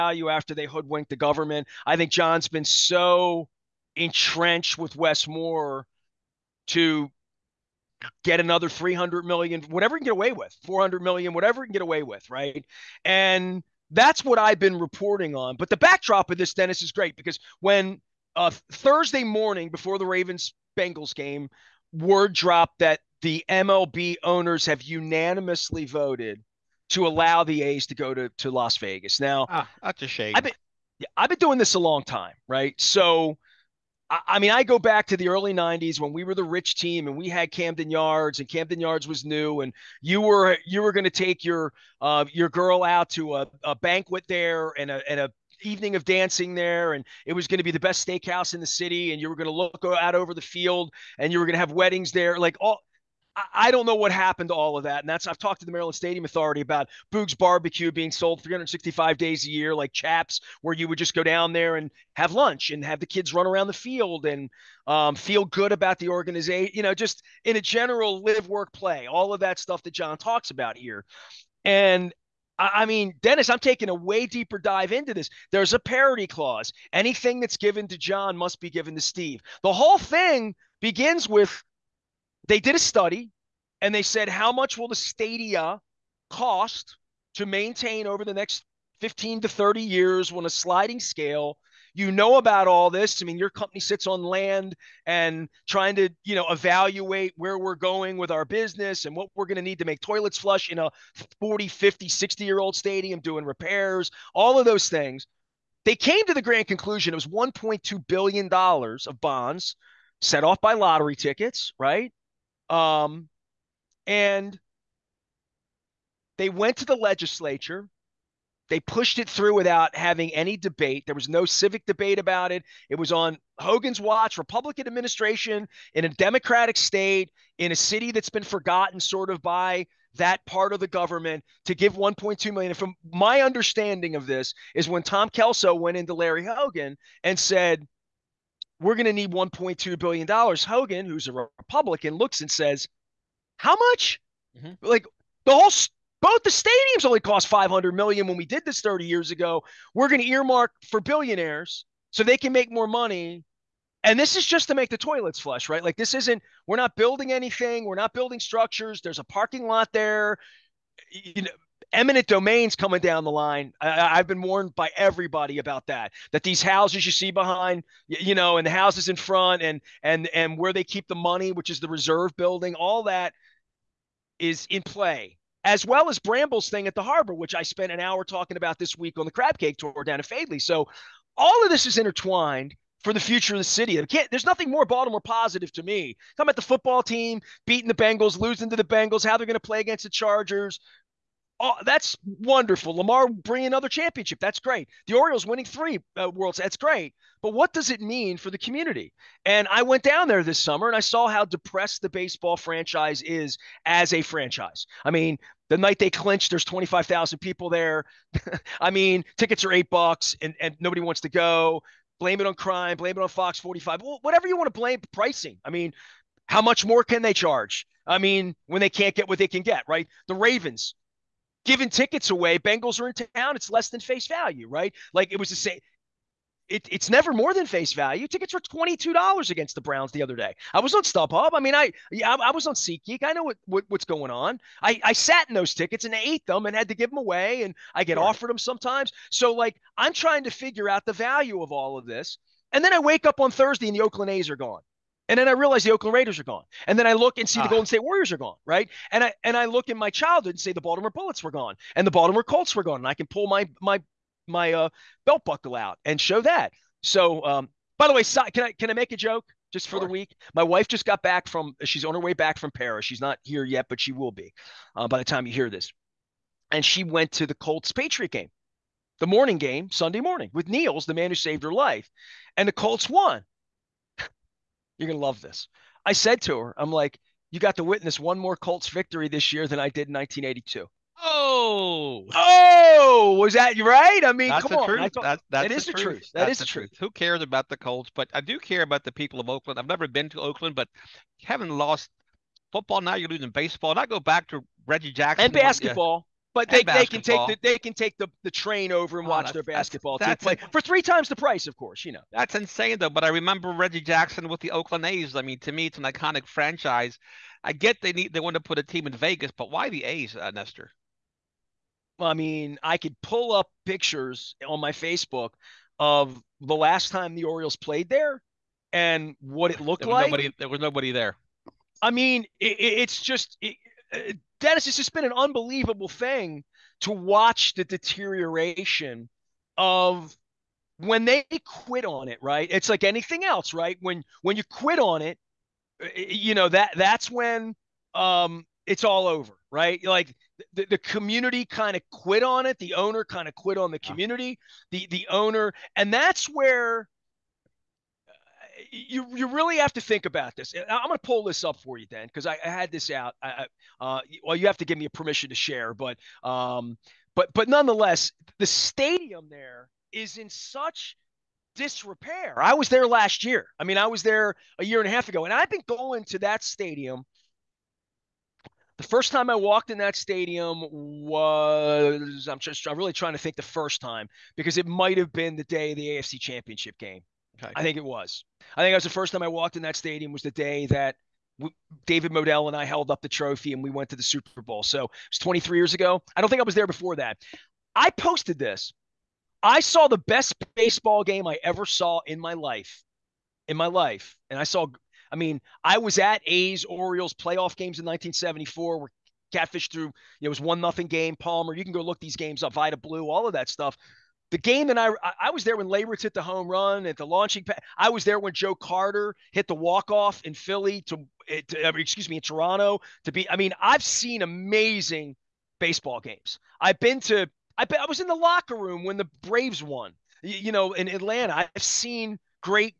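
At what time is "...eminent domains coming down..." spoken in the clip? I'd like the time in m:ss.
2:41.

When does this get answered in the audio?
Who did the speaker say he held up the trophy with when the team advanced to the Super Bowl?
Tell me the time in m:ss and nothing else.
6:22.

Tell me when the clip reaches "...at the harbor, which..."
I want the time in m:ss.
2:56.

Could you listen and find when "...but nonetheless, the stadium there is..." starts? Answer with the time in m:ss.
5:57.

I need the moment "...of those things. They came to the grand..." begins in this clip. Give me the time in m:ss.
1:44.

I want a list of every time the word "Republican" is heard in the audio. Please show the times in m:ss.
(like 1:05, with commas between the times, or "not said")
2:04, 2:21.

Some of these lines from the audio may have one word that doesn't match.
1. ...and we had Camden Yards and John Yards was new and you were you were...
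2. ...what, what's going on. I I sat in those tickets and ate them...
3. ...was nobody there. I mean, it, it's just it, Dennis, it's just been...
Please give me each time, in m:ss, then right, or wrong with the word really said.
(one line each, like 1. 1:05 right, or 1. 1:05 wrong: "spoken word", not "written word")
1. 0:37 wrong: "Camden", not "John"
2. 3:53 right
3. 5:20 right.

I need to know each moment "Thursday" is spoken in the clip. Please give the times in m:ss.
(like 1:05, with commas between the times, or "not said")
0:18, 4:03.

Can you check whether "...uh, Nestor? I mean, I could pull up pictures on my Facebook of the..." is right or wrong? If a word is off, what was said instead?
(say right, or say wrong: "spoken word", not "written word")
right.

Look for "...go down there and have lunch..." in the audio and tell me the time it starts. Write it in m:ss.
1:01.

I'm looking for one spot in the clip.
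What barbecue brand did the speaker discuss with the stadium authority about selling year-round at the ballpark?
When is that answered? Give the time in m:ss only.
0:57.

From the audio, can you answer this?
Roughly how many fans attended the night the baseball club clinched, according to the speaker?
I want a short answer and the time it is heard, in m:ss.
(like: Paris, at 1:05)
25,000, at 3:26.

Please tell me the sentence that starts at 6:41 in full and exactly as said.
You can go look these games up, Vida Blue, all of that stuff.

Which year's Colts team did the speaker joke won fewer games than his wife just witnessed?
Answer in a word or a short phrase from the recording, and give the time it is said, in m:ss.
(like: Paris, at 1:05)
1982, at 4:40.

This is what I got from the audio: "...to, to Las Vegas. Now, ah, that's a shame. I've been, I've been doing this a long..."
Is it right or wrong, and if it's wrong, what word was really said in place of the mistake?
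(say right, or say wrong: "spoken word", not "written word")
right.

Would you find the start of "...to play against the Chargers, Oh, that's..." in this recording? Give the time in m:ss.
3:09.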